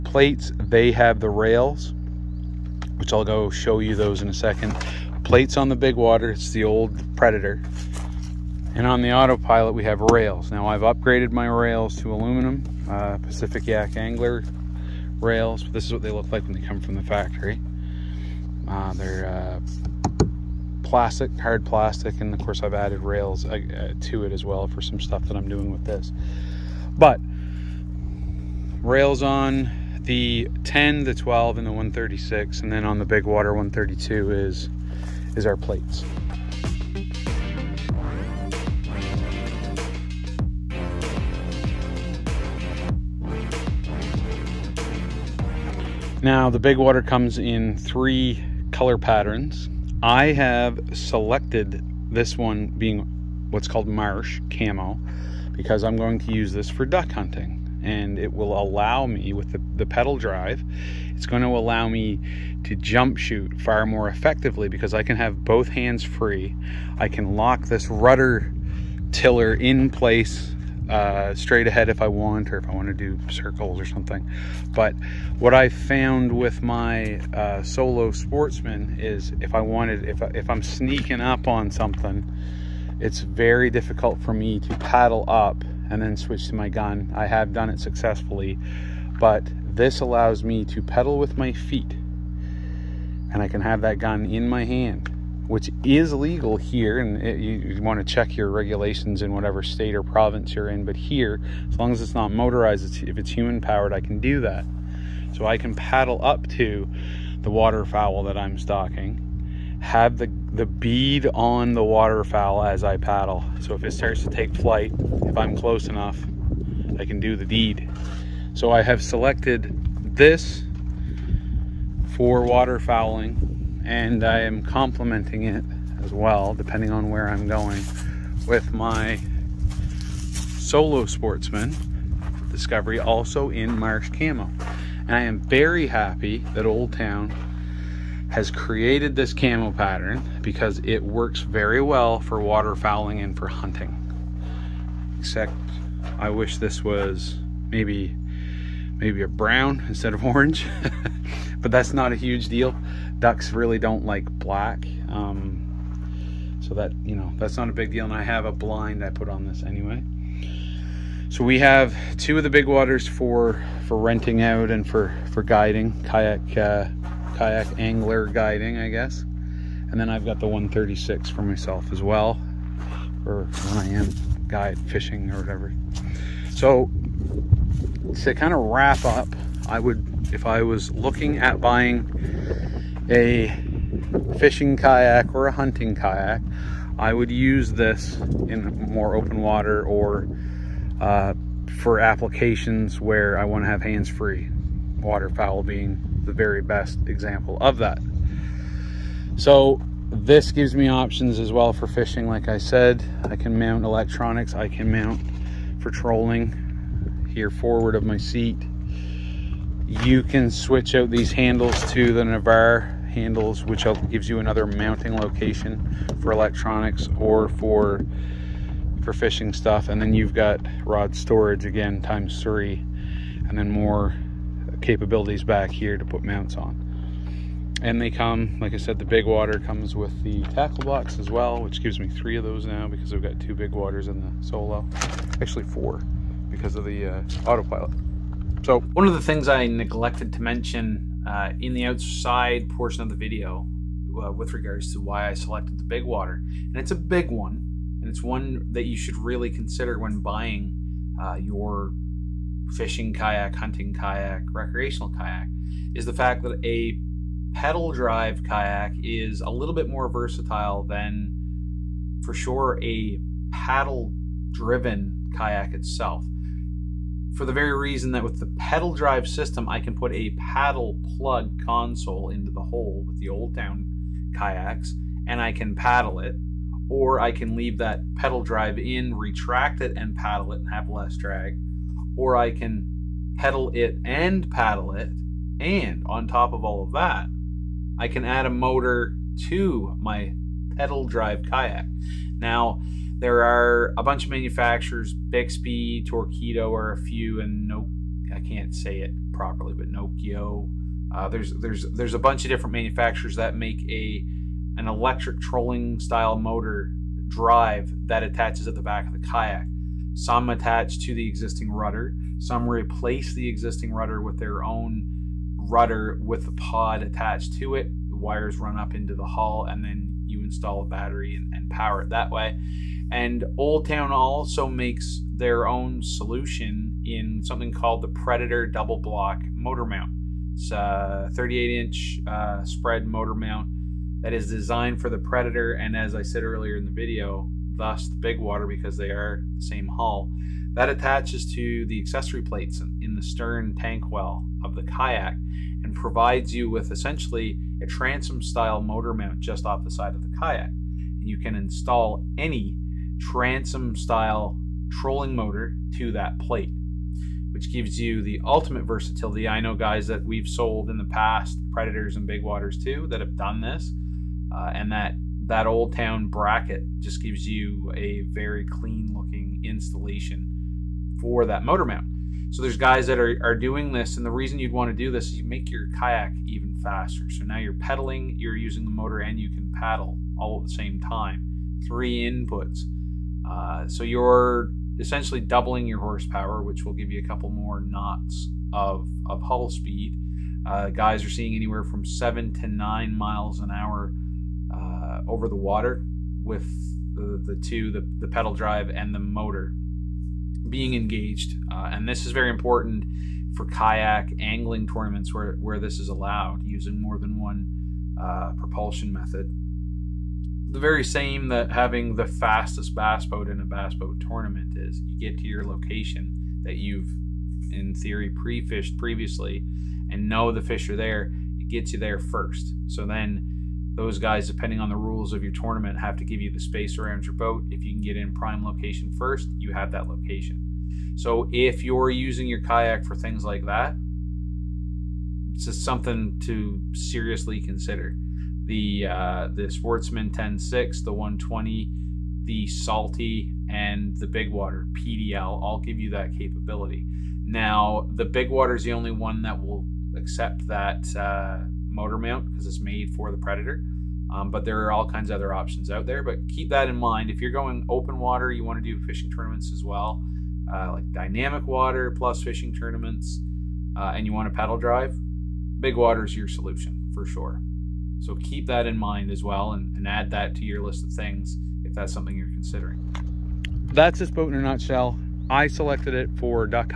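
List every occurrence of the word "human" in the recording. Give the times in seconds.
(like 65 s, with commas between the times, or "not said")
103 s.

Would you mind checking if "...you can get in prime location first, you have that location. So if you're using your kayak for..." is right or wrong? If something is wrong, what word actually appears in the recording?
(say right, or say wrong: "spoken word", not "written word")
right.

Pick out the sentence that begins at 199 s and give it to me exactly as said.
So this gives me options as well for fishing.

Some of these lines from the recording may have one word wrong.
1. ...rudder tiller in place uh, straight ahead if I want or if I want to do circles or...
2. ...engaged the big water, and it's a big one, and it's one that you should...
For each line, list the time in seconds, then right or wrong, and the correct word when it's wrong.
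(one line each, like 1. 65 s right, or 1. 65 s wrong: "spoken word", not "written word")
1. 67 s right
2. 245 s wrong: "selected", not "engaged".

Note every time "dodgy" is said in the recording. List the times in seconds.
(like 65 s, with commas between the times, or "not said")
not said.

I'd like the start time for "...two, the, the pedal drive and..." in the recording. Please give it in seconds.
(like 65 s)
397 s.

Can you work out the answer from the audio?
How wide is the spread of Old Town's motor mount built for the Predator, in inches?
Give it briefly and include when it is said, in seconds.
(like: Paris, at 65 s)
38 inches, at 331 s.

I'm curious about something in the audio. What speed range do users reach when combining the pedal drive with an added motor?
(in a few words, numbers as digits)
7 to 9 miles an hour.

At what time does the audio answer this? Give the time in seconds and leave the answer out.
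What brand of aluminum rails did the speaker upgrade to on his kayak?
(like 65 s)
13 s.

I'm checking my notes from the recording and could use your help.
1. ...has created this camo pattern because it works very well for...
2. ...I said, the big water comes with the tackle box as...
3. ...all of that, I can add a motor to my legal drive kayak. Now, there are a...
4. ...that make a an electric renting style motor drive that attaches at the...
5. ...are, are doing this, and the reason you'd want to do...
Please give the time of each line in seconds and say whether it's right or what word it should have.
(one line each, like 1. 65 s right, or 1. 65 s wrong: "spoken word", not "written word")
1. 138 s right
2. 228 s right
3. 286 s wrong: "pedal", not "legal"
4. 303 s wrong: "trolling", not "renting"
5. 373 s right.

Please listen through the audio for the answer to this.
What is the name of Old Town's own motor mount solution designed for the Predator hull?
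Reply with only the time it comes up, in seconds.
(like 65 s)
328 s.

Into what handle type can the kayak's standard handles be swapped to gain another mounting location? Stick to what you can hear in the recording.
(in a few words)
Navarre.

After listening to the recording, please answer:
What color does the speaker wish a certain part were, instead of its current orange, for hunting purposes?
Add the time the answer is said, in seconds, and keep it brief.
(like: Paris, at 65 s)
brown, at 149 s.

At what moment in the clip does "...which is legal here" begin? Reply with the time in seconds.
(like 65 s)
95 s.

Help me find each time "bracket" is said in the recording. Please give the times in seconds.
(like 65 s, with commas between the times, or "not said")
366 s.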